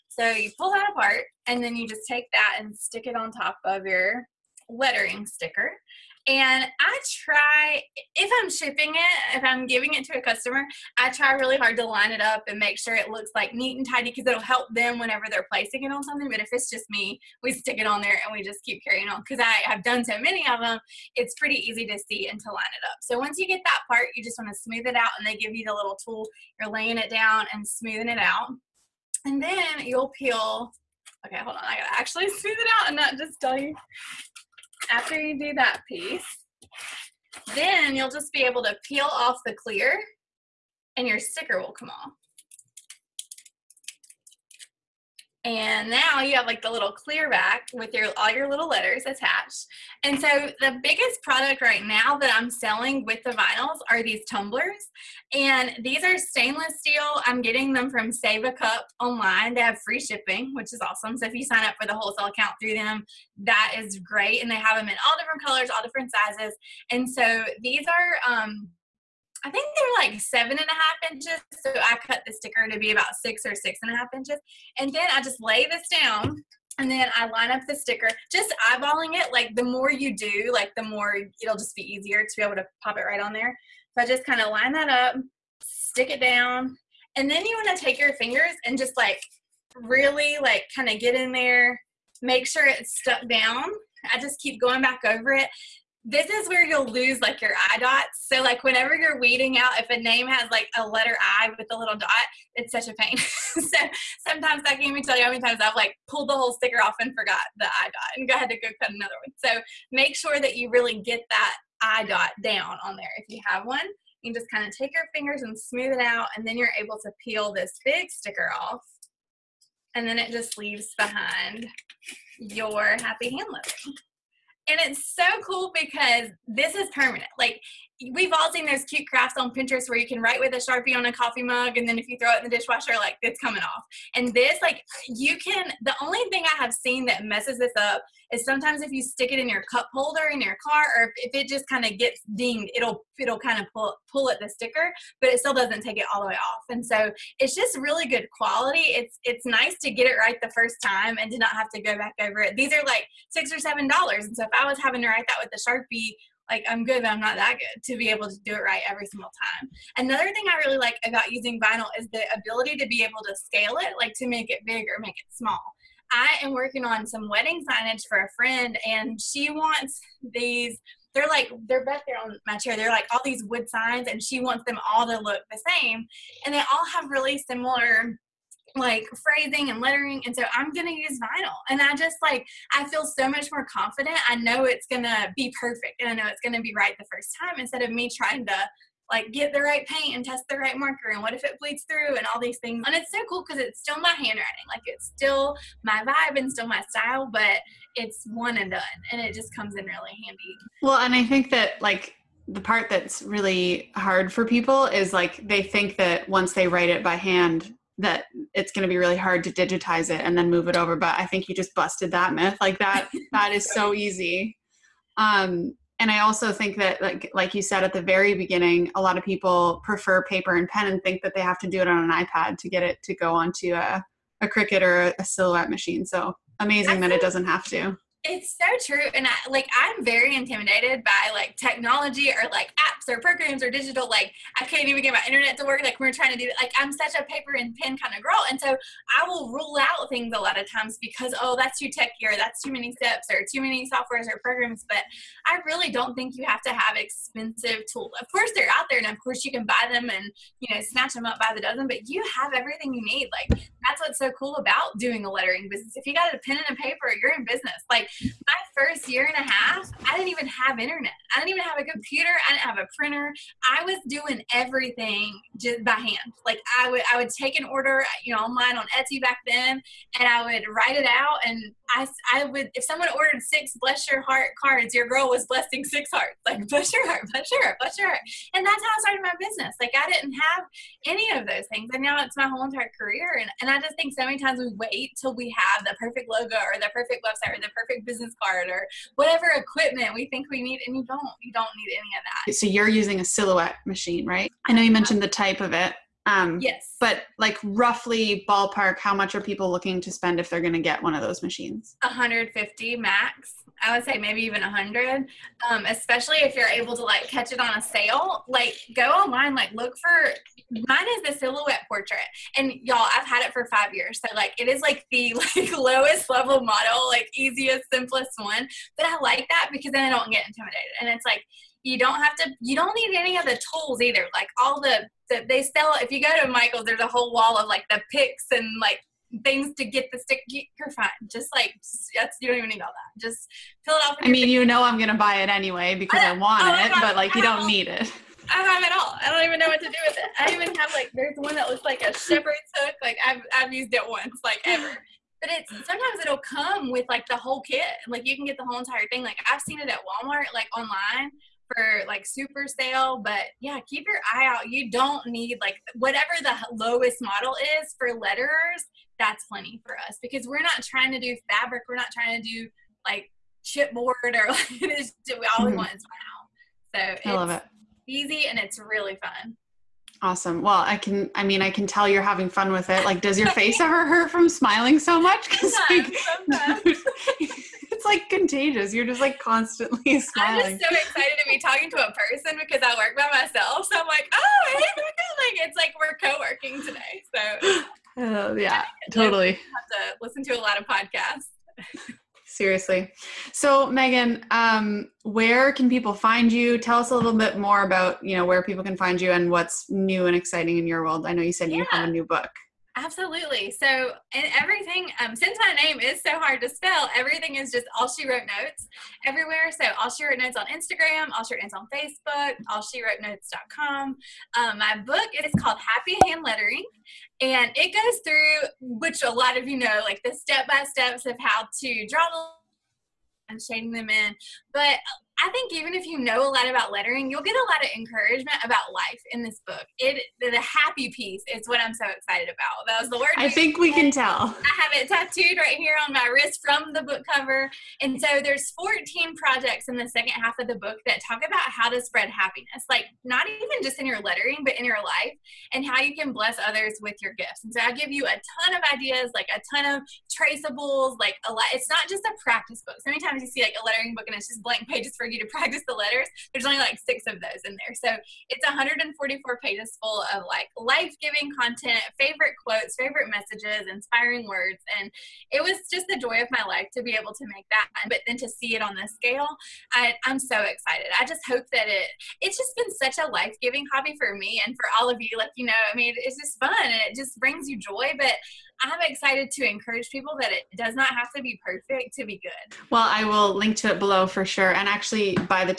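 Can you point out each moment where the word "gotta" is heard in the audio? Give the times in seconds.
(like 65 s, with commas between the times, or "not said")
31 s.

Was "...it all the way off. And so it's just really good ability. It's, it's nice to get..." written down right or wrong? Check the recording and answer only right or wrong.
wrong.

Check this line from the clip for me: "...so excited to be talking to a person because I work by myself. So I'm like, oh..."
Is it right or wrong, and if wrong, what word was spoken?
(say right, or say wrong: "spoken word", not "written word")
right.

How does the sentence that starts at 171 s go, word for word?
They're like they're back there on my chair.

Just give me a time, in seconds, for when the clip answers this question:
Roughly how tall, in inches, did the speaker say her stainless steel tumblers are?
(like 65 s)
70 s.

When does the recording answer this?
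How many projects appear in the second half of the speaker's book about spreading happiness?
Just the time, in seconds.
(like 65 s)
438 s.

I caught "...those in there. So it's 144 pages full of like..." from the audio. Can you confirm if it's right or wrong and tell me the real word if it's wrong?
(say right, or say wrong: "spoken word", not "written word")
right.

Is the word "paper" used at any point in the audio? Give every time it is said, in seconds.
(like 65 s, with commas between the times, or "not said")
220 s, 237 s, 256 s.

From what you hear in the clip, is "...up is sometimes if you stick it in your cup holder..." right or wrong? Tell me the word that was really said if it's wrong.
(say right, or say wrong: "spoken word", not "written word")
right.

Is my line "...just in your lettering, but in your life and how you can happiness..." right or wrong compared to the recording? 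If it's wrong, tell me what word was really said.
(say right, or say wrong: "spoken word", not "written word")
wrong: "bless", not "happiness".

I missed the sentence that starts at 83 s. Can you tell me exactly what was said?
So I just kind of line that up, stick it down.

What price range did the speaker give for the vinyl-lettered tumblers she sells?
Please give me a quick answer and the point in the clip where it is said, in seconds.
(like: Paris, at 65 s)
$6 or $7, at 153 s.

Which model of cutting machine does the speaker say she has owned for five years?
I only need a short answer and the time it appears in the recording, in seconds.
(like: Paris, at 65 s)
Silhouette Portrait, at 311 s.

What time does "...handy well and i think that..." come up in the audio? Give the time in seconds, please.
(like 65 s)
200 s.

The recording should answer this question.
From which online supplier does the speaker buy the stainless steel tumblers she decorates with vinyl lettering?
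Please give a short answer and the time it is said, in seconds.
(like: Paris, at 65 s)
Save a Cup, at 58 s.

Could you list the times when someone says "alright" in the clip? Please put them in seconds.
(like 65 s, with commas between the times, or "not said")
not said.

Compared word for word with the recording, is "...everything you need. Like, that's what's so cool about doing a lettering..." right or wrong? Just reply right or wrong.
right.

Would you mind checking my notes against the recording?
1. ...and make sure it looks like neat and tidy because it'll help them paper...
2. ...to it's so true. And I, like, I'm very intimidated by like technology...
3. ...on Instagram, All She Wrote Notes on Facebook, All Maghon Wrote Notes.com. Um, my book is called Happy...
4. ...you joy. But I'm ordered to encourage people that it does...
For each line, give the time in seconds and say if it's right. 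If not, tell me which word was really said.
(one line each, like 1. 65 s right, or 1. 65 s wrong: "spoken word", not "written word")
1. 12 s wrong: "whenever", not "paper"
2. 227 s right
3. 410 s wrong: "She", not "Maghon"
4. 477 s wrong: "excited", not "ordered".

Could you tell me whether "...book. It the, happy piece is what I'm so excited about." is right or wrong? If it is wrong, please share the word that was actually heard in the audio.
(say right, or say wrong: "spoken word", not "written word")
right.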